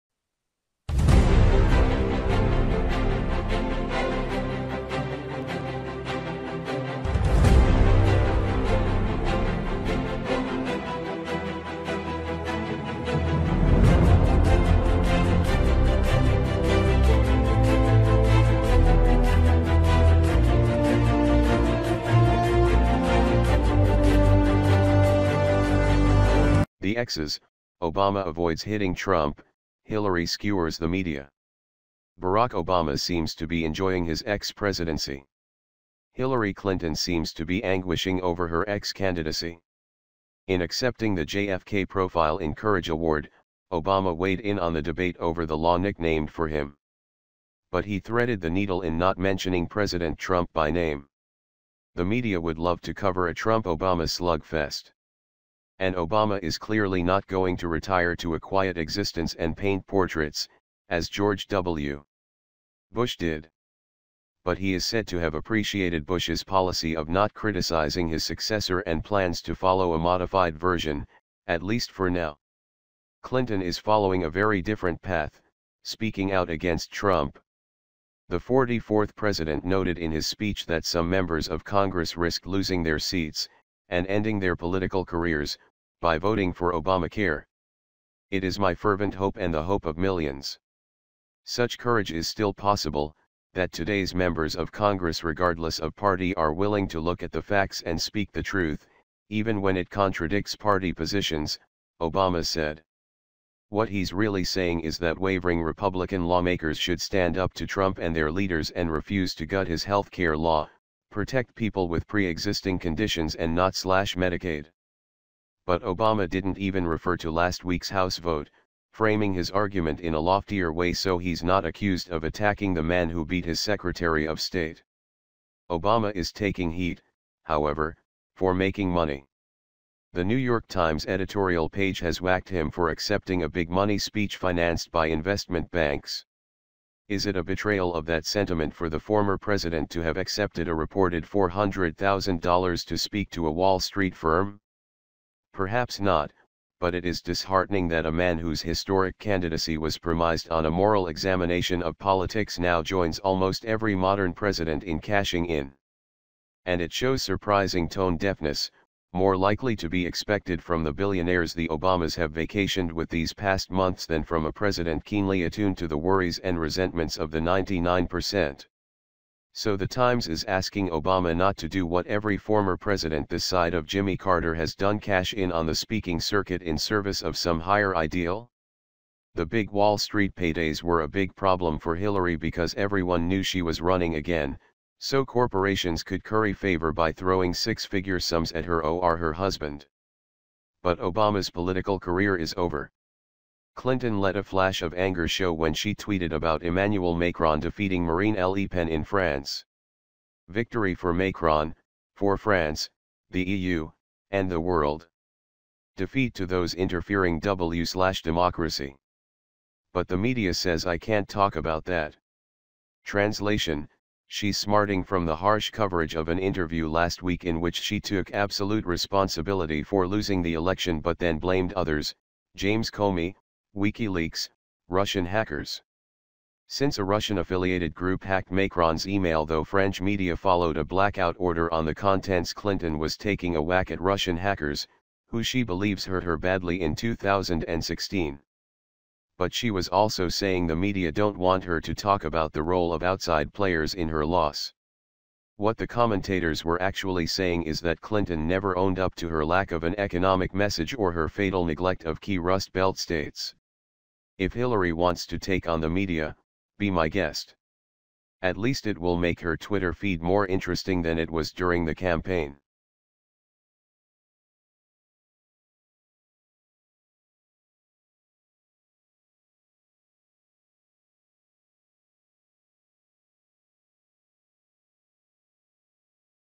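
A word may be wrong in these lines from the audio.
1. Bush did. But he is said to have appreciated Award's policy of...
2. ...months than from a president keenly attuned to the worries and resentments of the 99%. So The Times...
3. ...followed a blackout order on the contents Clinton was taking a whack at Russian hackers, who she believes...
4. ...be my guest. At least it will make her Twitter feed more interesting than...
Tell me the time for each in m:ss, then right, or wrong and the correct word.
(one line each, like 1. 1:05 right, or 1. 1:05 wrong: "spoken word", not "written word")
1. 1:02 wrong: "Bush", not "Award"
2. 2:43 right
3. 3:50 right
4. 4:16 right.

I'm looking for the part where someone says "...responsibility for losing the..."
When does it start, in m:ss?
3:38.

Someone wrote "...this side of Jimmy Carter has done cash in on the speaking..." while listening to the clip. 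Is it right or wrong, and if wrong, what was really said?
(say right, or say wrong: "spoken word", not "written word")
right.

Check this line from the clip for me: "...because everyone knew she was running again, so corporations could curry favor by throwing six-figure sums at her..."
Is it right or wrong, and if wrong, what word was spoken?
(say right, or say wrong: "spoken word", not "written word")
right.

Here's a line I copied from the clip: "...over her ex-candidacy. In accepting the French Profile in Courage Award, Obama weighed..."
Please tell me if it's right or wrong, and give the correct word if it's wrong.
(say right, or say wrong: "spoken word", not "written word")
wrong: "JFK", not "French".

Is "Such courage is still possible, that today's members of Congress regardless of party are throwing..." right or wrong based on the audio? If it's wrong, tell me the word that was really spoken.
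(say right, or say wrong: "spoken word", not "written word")
wrong: "willing", not "throwing".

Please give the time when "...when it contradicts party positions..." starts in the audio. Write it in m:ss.
1:39.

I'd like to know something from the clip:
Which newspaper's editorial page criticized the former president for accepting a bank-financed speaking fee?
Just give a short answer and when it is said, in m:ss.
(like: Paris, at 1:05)
The New York Times, at 2:10.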